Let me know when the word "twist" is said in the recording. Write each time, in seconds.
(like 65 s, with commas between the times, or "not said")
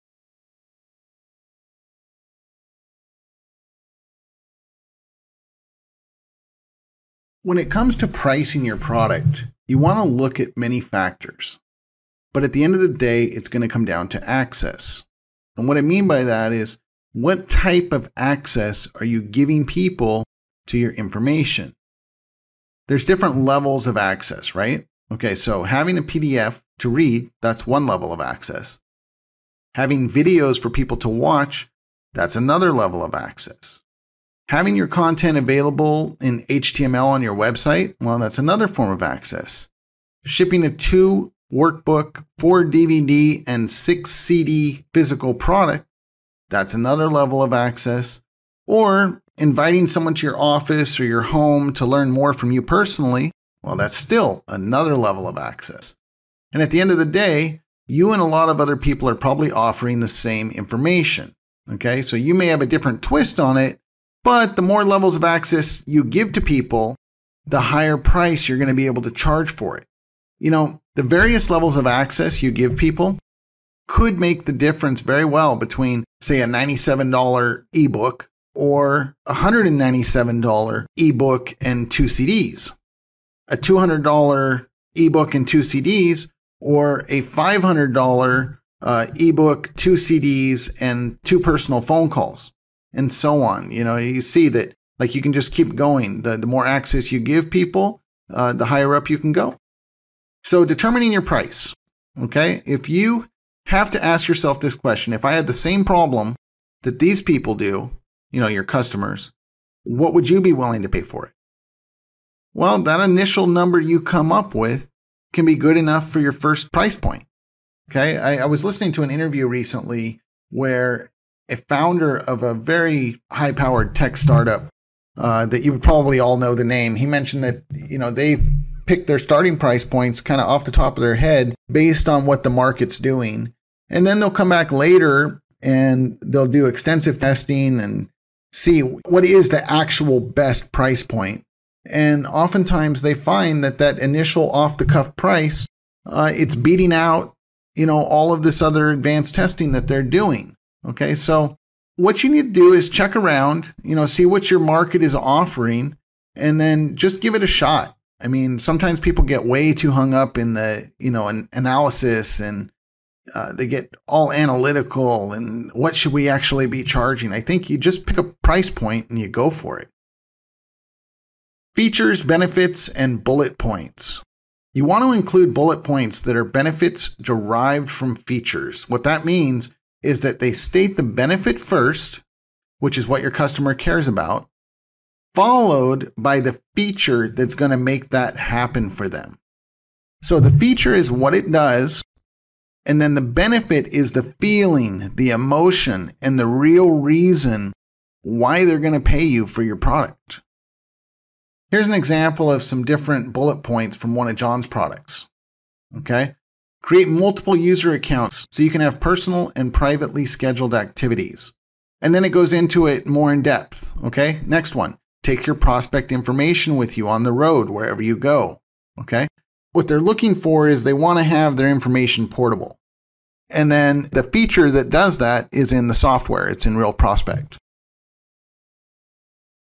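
63 s.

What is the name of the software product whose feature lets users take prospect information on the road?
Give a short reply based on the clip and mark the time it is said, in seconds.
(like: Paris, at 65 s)
Real Prospect, at 226 s.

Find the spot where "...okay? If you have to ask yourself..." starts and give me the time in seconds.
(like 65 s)
102 s.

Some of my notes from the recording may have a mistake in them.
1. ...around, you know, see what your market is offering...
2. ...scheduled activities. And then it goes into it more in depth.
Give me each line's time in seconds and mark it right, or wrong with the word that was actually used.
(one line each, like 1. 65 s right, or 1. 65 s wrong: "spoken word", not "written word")
1. 153 s right
2. 210 s right.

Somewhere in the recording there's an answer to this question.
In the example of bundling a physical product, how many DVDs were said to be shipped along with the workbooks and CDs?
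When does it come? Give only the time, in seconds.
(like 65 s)
42 s.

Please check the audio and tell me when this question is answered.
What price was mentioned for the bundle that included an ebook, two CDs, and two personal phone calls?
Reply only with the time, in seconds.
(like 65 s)
87 s.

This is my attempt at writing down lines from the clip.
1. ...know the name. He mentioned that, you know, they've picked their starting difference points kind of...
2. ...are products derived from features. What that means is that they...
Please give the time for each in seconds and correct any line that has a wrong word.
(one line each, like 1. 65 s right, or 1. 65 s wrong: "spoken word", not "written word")
1. 126 s wrong: "price", not "difference"
2. 176 s wrong: "benefits", not "products".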